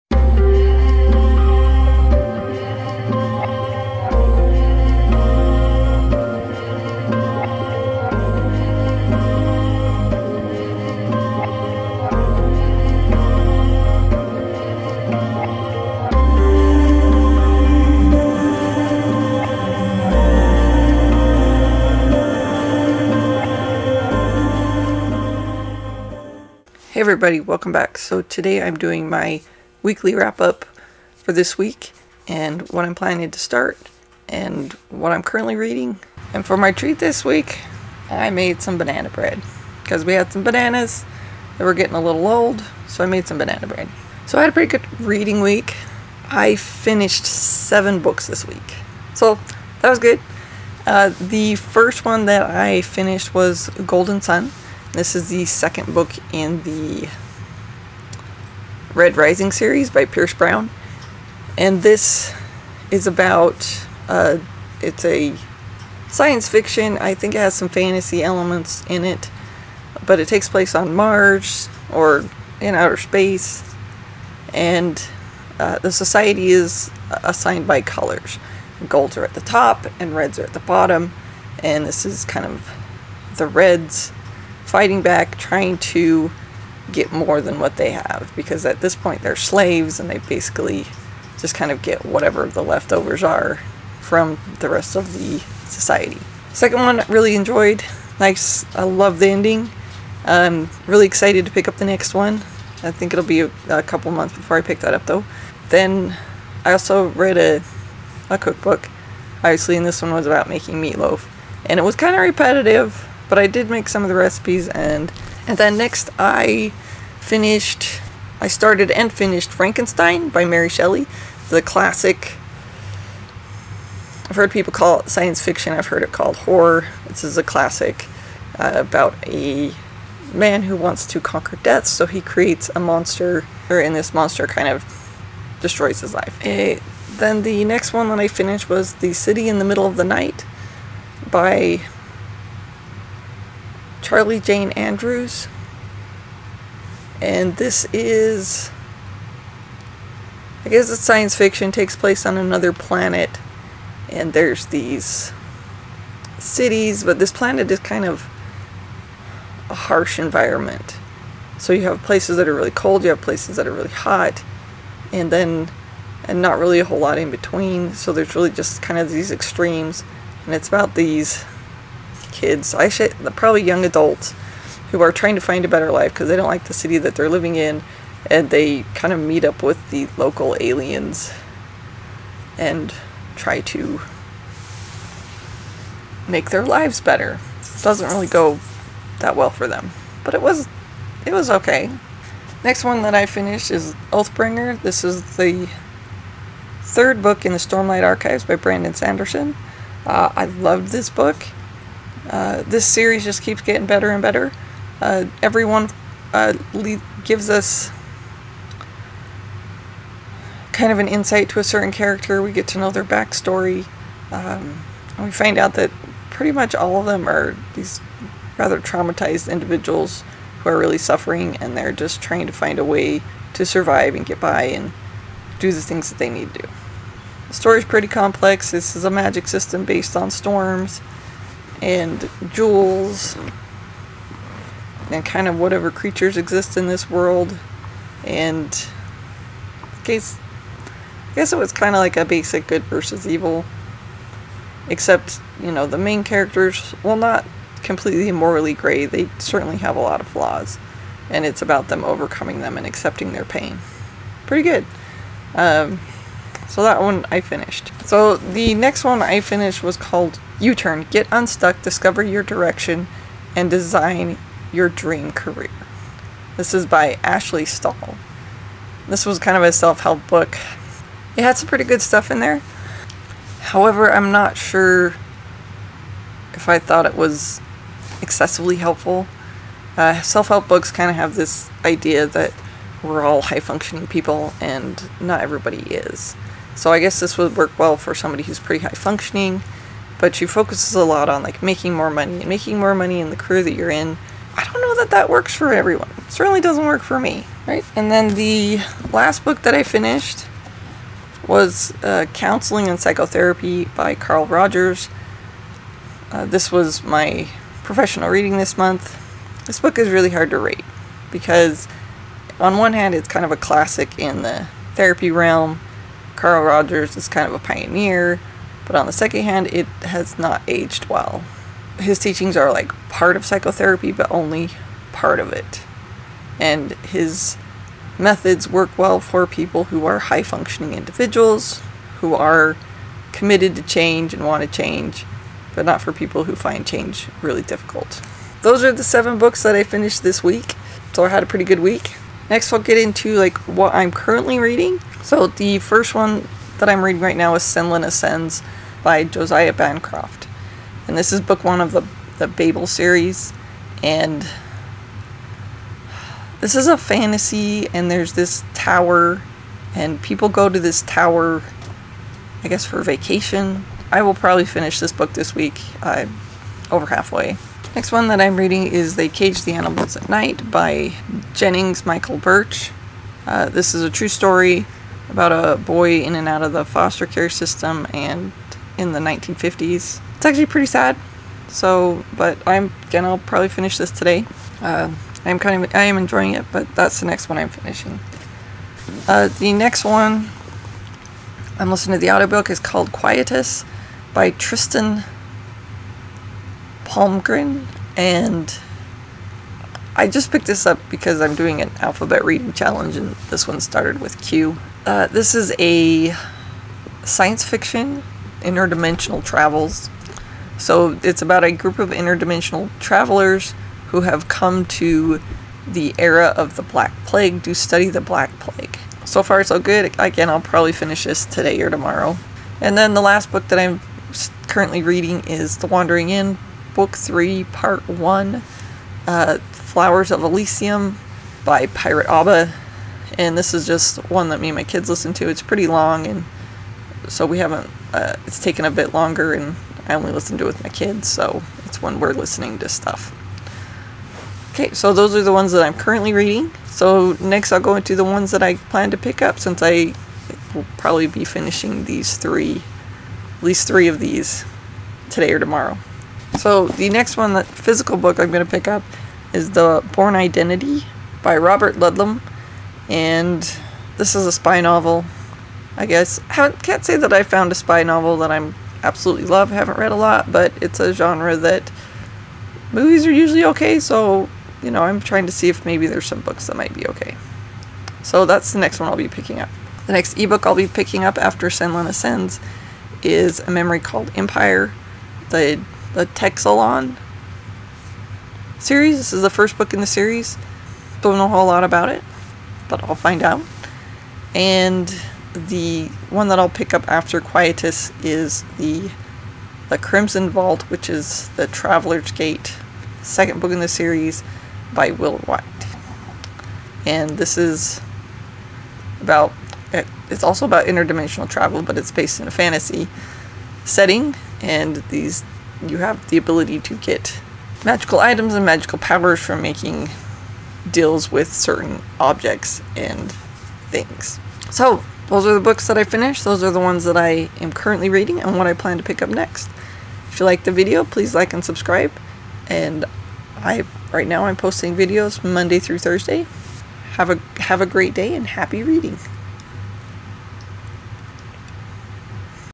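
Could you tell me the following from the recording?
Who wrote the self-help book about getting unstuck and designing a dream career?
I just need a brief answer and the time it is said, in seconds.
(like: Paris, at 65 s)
Ashley Stahl, at 267 s.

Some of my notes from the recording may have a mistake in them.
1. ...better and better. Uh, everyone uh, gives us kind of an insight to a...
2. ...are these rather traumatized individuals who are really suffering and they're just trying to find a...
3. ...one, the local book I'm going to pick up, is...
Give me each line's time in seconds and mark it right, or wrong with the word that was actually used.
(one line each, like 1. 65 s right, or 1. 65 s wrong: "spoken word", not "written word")
1. 203 s right
2. 217 s right
3. 457 s wrong: "physical", not "local".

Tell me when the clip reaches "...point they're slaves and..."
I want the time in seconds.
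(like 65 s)
88 s.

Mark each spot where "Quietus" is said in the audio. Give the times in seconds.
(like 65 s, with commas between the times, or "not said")
393 s, 497 s.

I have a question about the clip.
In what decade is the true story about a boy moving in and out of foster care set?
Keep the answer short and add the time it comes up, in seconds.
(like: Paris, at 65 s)
1950s, at 379 s.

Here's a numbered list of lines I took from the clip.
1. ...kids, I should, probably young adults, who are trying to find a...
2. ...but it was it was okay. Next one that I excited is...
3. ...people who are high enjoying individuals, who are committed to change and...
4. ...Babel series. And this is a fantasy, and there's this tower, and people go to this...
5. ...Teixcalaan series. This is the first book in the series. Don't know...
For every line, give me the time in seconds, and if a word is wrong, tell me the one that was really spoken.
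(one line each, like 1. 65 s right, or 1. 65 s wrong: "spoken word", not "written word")
1. 172 s right
2. 190 s wrong: "finished", not "excited"
3. 329 s wrong: "functioning", not "enjoying"
4. 352 s right
5. 486 s right.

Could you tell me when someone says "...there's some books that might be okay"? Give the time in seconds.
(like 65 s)
476 s.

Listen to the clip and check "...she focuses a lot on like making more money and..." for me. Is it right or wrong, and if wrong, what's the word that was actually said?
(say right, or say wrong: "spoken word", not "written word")
right.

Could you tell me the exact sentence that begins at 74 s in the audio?
And uh, the society is assigned by colors.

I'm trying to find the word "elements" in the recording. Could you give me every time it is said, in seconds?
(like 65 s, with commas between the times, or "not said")
68 s.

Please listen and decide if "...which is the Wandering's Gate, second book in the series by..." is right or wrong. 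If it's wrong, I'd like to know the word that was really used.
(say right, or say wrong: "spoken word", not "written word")
wrong: "Traveler", not "Wandering".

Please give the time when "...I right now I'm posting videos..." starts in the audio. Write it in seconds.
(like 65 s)
533 s.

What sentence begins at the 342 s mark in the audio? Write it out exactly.
Next, I'll get into like what I'm currently reading.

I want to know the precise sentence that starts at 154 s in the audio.
And there's these cities, but this planet is kind of a harsh environment.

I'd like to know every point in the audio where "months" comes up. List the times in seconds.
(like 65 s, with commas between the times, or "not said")
104 s, 308 s.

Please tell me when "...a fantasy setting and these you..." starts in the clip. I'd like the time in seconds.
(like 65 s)
512 s.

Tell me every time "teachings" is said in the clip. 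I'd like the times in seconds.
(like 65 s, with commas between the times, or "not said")
322 s.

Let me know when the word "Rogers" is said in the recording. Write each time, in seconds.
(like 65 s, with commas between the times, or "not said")
304 s, 316 s.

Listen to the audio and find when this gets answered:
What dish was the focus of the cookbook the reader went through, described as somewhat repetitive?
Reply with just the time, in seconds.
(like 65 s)
110 s.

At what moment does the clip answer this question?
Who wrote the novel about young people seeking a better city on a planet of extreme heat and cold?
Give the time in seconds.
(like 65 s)
144 s.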